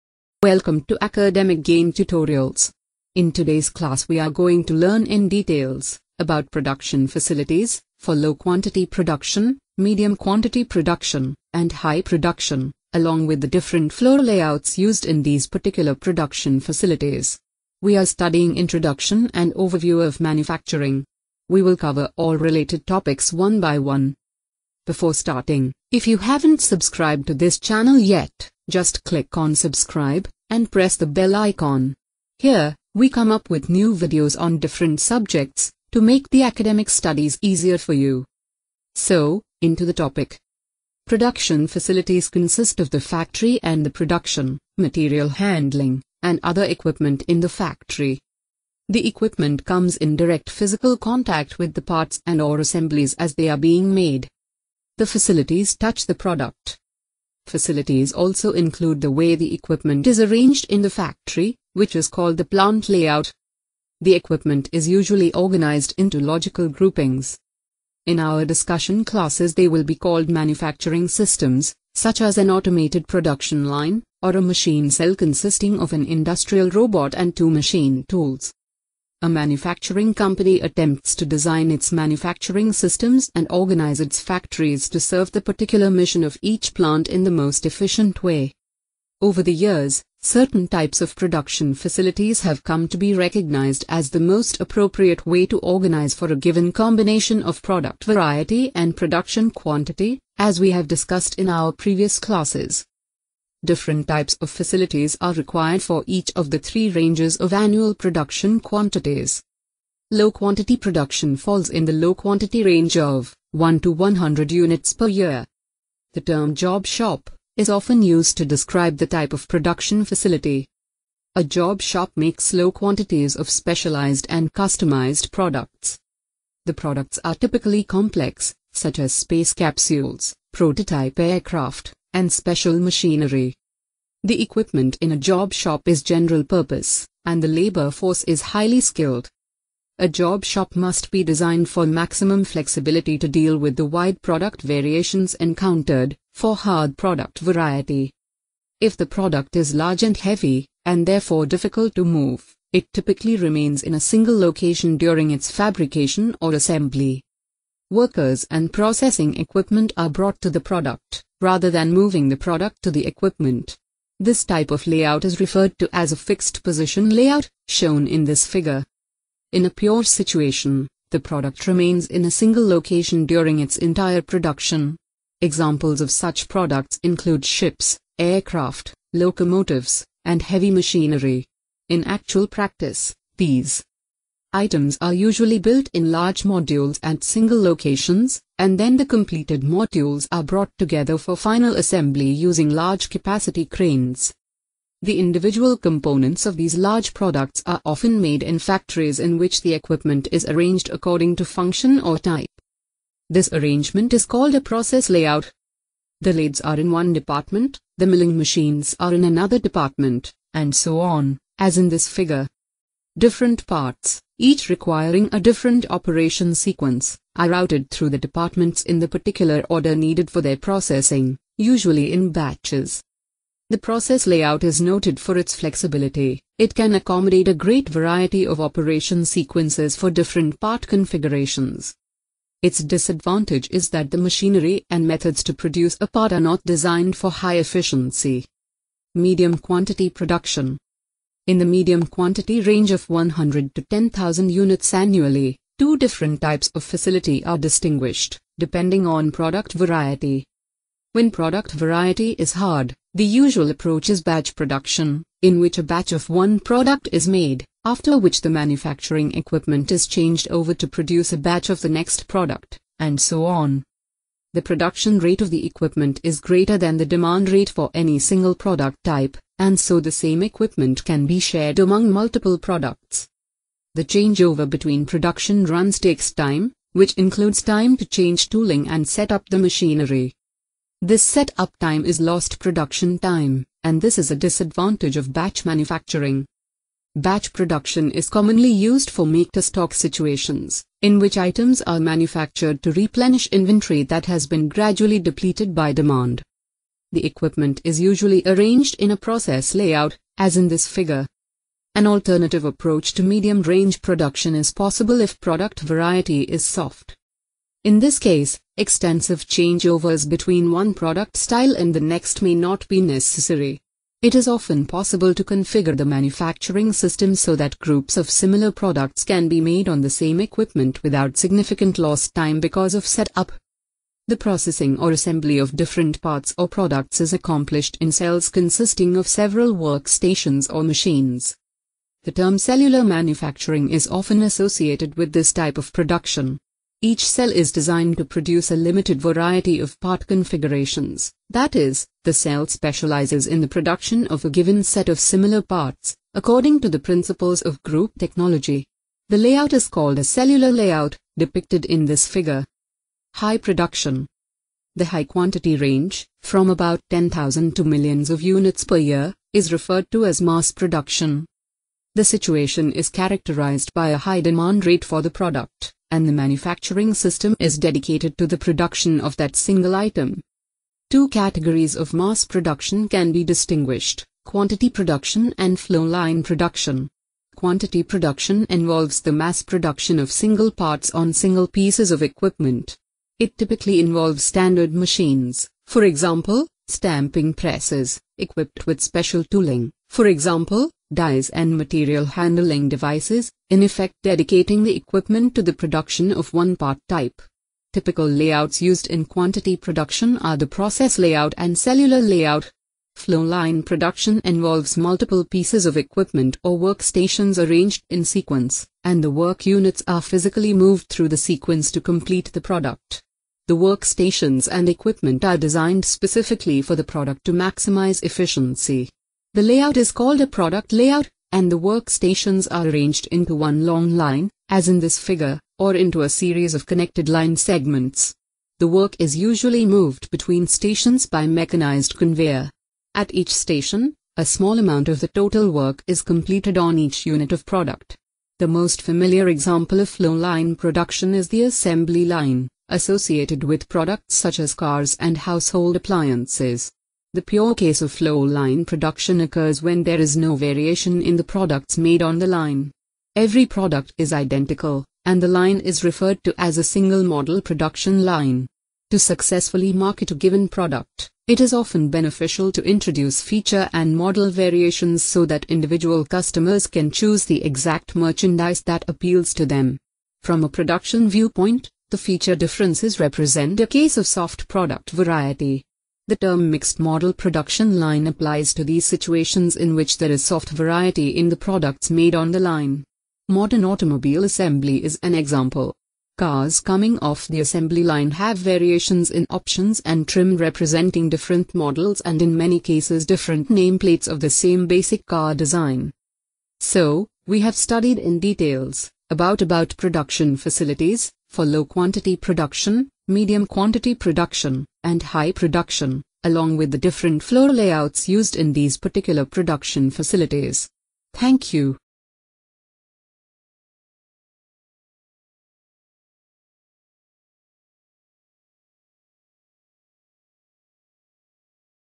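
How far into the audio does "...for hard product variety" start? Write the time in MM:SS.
02:26.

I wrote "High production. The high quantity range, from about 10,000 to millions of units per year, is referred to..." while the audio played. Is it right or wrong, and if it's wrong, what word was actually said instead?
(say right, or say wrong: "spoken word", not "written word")
right.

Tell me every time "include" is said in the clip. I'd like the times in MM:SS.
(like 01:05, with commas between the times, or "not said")
00:58, 02:57, 04:37.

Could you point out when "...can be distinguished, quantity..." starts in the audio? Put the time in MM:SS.
06:13.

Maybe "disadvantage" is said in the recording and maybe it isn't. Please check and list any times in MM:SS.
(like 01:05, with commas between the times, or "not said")
03:52, 04:44.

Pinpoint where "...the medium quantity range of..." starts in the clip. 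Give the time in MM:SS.
04:01.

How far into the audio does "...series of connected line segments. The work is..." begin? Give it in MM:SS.
07:06.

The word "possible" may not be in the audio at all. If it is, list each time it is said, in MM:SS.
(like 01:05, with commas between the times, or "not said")
05:04, 05:14.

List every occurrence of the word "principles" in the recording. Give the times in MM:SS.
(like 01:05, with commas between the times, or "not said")
05:46.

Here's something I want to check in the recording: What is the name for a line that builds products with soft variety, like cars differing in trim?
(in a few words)
mixed model production line.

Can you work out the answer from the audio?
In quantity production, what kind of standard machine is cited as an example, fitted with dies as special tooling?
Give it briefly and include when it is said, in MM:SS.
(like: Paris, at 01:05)
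stamping presses, at 06:26.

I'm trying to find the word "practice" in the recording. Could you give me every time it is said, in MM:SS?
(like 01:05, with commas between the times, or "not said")
03:02.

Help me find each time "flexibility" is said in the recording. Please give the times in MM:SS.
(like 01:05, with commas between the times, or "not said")
02:22, 03:45.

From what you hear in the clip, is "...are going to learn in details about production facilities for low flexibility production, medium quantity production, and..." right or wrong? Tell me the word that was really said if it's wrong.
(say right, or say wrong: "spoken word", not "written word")
wrong: "quantity", not "flexibility".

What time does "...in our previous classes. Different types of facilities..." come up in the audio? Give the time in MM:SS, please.
01:41.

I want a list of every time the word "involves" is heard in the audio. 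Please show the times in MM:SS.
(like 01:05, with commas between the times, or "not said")
06:18, 06:23, 06:44.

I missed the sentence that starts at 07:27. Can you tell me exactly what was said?
The pure case of flow line production occurs when there is no variation in the products made on the line.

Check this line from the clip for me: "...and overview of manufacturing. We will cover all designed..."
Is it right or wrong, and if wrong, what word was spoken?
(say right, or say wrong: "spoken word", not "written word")
wrong: "related", not "designed".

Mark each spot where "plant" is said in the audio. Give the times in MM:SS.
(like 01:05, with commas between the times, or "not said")
01:02, 01:26.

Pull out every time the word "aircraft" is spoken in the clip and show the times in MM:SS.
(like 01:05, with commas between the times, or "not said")
02:11, 02:58.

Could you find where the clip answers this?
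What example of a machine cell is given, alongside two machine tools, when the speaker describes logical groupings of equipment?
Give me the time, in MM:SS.
01:16.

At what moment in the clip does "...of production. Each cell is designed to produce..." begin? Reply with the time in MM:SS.
05:35.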